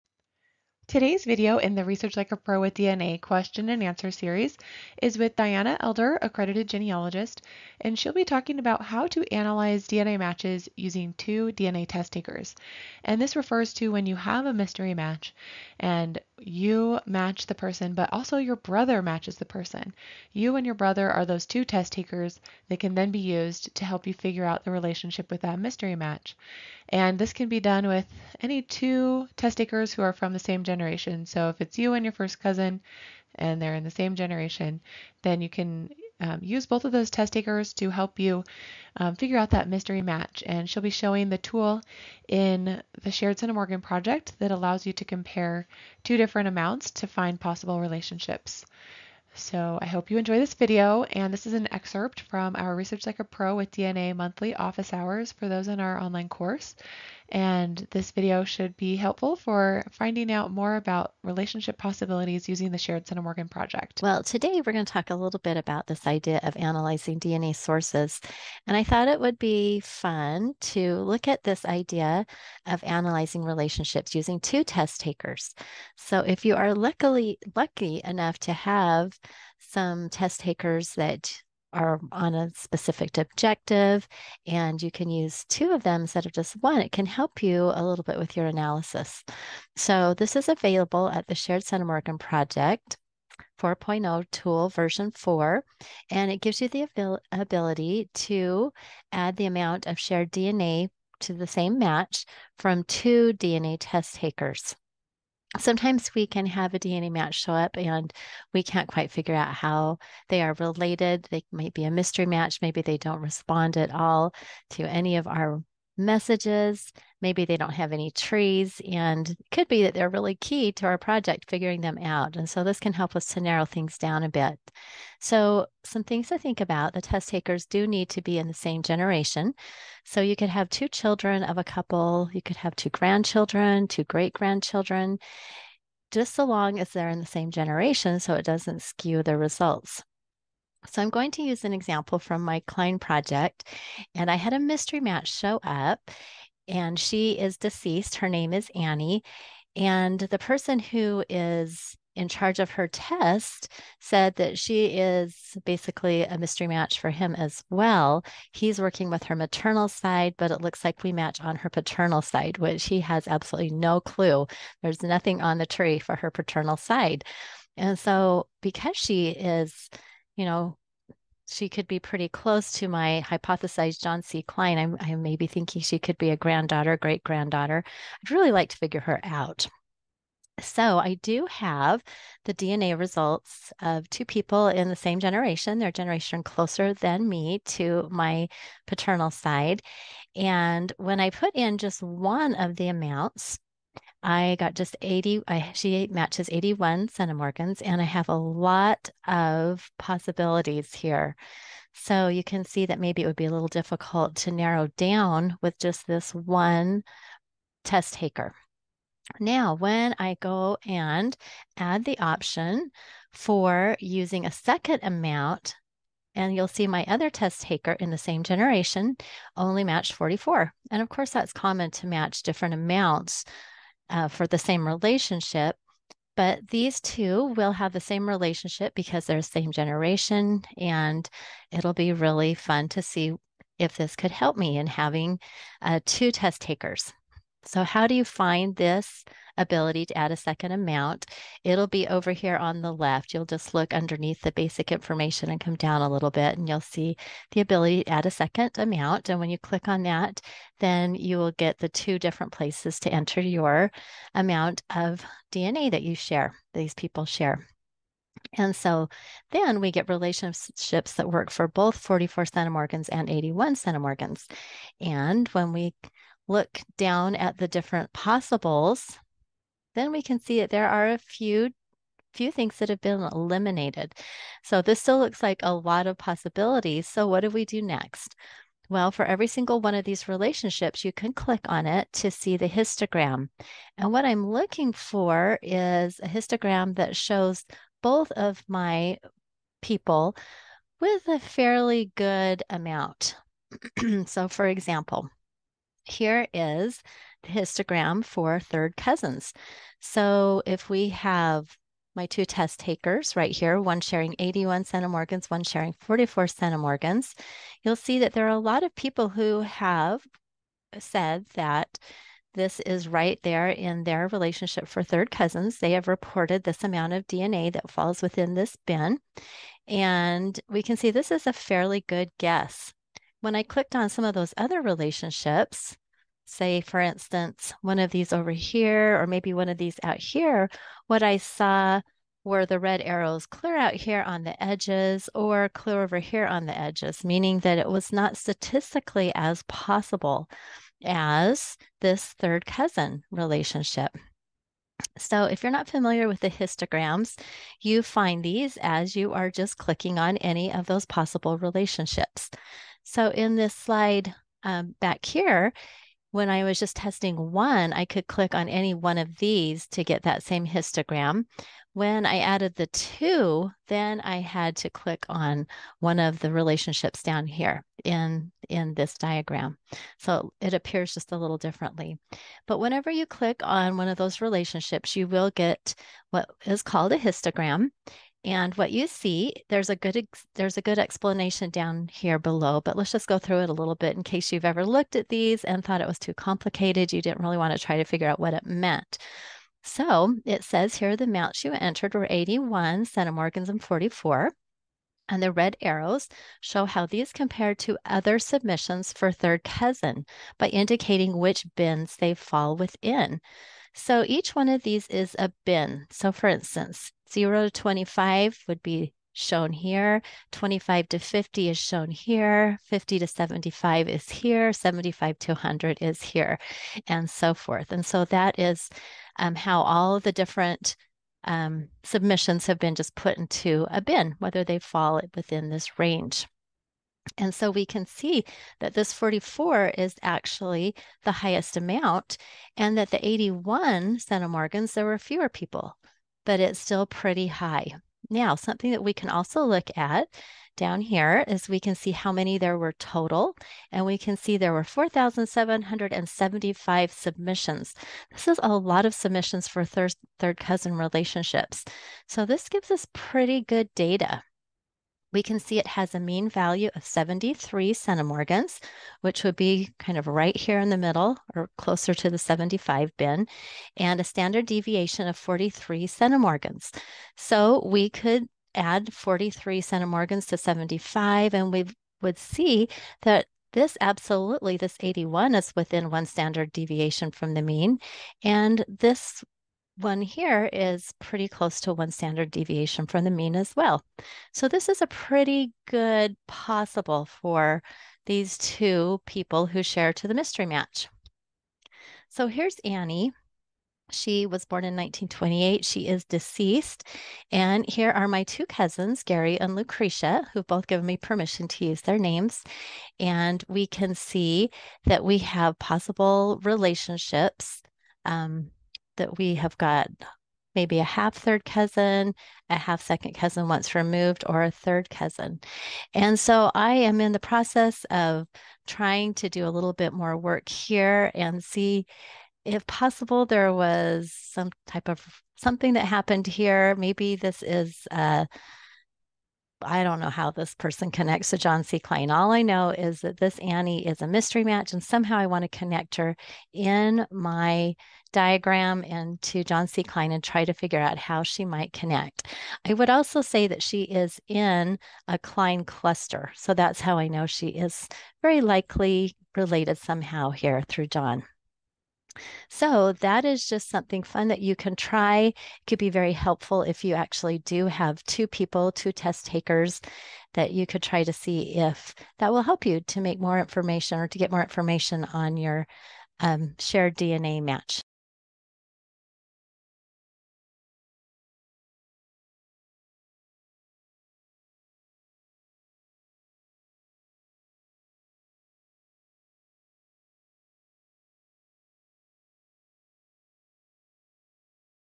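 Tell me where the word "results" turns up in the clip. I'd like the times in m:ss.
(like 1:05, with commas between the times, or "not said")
2:19, 3:02.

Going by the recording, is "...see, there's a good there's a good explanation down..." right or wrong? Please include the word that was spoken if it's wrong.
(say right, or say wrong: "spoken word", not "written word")
right.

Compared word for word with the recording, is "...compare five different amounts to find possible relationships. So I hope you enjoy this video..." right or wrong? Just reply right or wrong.
wrong.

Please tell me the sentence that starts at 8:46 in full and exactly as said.
Maybe this is uh, I don't know how this person connects to John C.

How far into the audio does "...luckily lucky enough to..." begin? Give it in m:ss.
1:16.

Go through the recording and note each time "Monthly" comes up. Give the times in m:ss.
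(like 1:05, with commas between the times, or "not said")
0:54.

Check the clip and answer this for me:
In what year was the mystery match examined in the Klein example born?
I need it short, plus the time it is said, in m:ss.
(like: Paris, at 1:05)
1928, at 8:14.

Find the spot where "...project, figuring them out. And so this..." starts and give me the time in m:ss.
2:00.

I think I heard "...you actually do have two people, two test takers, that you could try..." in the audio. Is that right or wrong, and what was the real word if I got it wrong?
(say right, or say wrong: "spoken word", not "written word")
right.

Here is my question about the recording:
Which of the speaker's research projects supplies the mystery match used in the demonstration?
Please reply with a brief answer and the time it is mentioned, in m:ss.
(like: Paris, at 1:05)
Klein project, at 2:22.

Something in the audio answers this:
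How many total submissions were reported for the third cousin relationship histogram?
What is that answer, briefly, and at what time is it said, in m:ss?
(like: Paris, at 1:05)
4,775, at 7:24.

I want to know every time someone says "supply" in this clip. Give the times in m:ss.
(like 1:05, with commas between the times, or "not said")
not said.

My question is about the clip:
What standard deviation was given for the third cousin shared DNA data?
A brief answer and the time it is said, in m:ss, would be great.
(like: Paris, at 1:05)
43 centimorgans, at 7:44.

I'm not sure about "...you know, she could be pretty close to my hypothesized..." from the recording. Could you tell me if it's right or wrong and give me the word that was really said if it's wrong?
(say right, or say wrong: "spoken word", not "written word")
right.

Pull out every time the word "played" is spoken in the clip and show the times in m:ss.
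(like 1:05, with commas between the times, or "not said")
not said.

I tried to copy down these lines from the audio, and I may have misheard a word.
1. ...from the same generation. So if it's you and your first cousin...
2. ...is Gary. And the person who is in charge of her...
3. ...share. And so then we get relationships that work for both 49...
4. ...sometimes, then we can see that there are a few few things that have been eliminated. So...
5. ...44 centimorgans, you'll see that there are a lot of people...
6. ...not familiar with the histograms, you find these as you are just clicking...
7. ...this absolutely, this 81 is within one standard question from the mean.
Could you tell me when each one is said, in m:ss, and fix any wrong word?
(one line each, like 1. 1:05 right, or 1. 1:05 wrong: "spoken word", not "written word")
1. 0:30 right
2. 2:28 wrong: "Annie", not "Gary"
3. 4:17 wrong: "44", not "49"
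4. 4:28 wrong: "possibles", not "sometimes"
5. 5:05 right
6. 5:45 right
7. 7:53 wrong: "deviation", not "question".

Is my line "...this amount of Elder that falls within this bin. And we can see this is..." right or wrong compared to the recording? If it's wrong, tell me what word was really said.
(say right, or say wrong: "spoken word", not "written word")
wrong: "DNA", not "Elder".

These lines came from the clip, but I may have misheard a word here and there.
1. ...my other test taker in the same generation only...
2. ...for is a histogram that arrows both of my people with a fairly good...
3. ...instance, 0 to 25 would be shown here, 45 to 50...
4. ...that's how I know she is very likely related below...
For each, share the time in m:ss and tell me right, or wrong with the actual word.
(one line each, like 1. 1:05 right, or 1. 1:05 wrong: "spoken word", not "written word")
1. 3:36 right
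2. 4:44 wrong: "shows", not "arrows"
3. 6:46 wrong: "25", not "45"
4. 9:06 wrong: "somehow", not "below".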